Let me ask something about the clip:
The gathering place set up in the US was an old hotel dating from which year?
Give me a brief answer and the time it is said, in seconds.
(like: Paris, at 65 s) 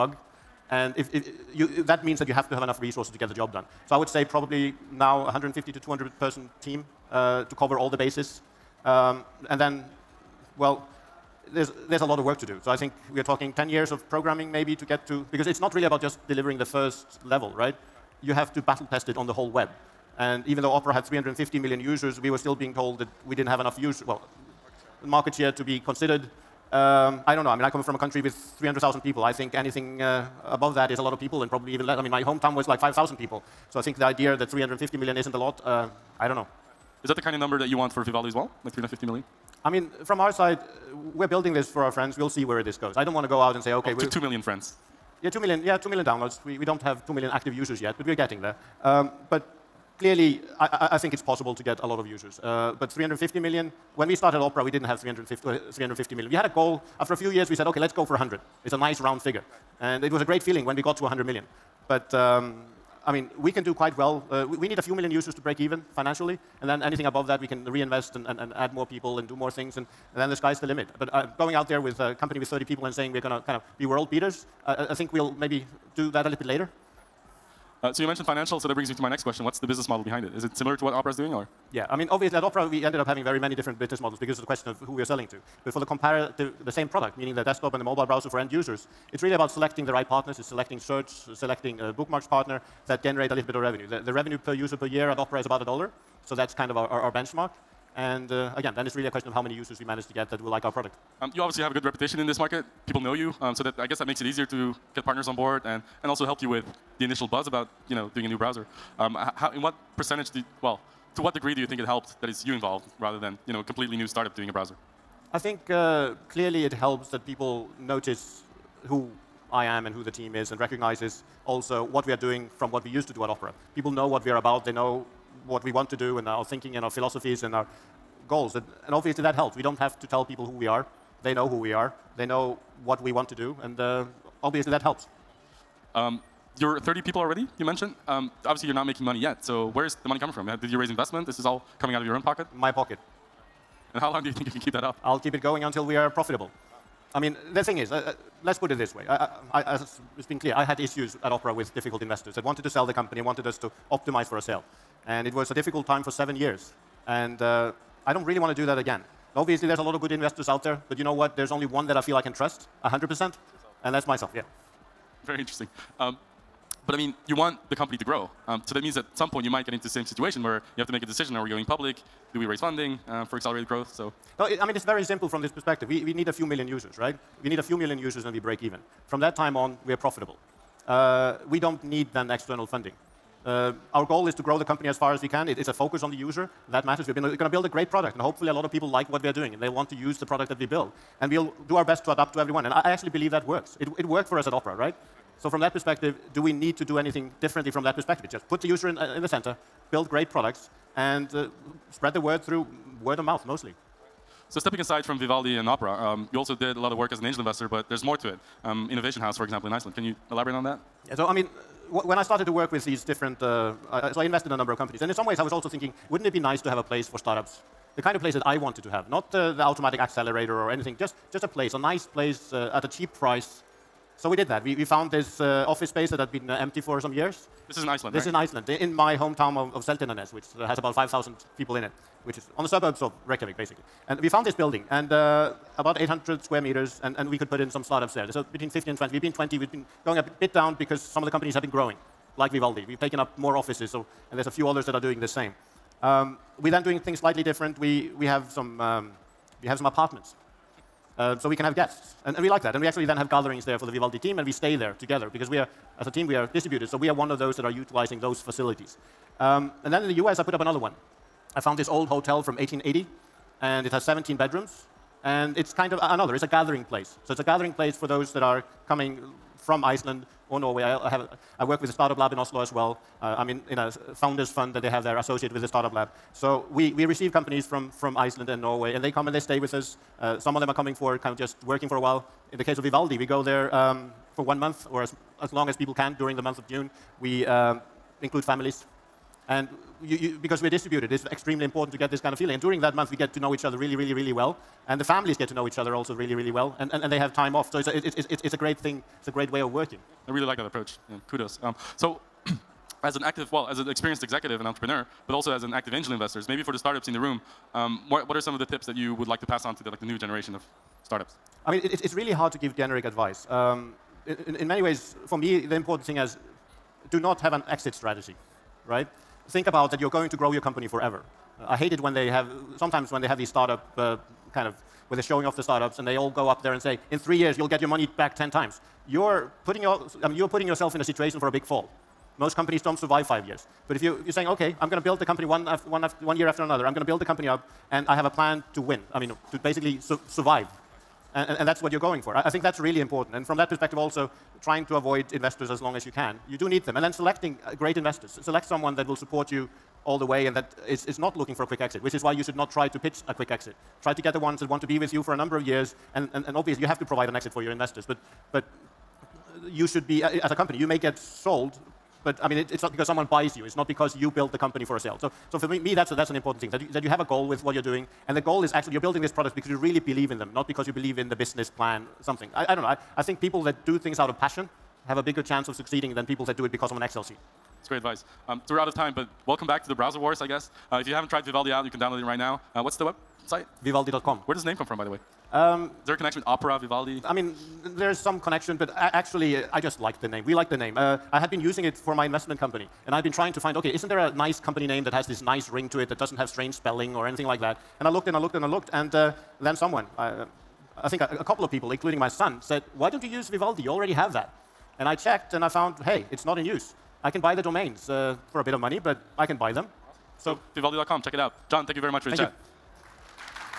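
1880, at 262 s.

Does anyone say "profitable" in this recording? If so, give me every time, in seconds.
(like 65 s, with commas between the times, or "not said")
146 s, 179 s.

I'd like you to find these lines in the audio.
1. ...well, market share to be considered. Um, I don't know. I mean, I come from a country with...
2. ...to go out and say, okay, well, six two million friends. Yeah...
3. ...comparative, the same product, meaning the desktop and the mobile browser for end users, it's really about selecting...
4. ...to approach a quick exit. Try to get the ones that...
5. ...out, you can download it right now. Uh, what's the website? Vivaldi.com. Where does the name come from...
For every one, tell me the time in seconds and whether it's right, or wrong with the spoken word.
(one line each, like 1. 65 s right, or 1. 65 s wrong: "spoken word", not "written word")
1. 24 s right
2. 43 s wrong: "two", not "six"
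3. 85 s right
4. 352 s wrong: "pitch", not "approach"
5. 381 s right.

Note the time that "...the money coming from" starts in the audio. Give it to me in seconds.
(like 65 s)
140 s.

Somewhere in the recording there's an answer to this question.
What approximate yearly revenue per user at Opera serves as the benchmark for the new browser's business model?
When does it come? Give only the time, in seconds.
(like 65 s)
95 s.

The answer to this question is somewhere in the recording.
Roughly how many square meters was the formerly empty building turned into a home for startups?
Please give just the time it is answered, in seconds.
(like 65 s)
235 s.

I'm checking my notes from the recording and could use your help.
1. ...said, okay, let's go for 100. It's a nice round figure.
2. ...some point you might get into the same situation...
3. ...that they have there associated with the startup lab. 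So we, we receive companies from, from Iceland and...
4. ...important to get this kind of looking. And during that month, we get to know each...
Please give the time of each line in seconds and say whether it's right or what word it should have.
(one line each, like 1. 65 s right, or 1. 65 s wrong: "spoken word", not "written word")
1. 57 s right
2. 169 s right
3. 274 s right
4. 291 s wrong: "feeling", not "looking".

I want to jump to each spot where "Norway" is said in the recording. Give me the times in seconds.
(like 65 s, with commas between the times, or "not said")
270 s, 278 s.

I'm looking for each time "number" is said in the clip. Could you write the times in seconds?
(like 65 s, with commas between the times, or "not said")
37 s, 214 s, 355 s.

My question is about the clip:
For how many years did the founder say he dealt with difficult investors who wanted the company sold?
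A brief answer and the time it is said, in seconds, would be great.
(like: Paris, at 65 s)
7, at 156 s.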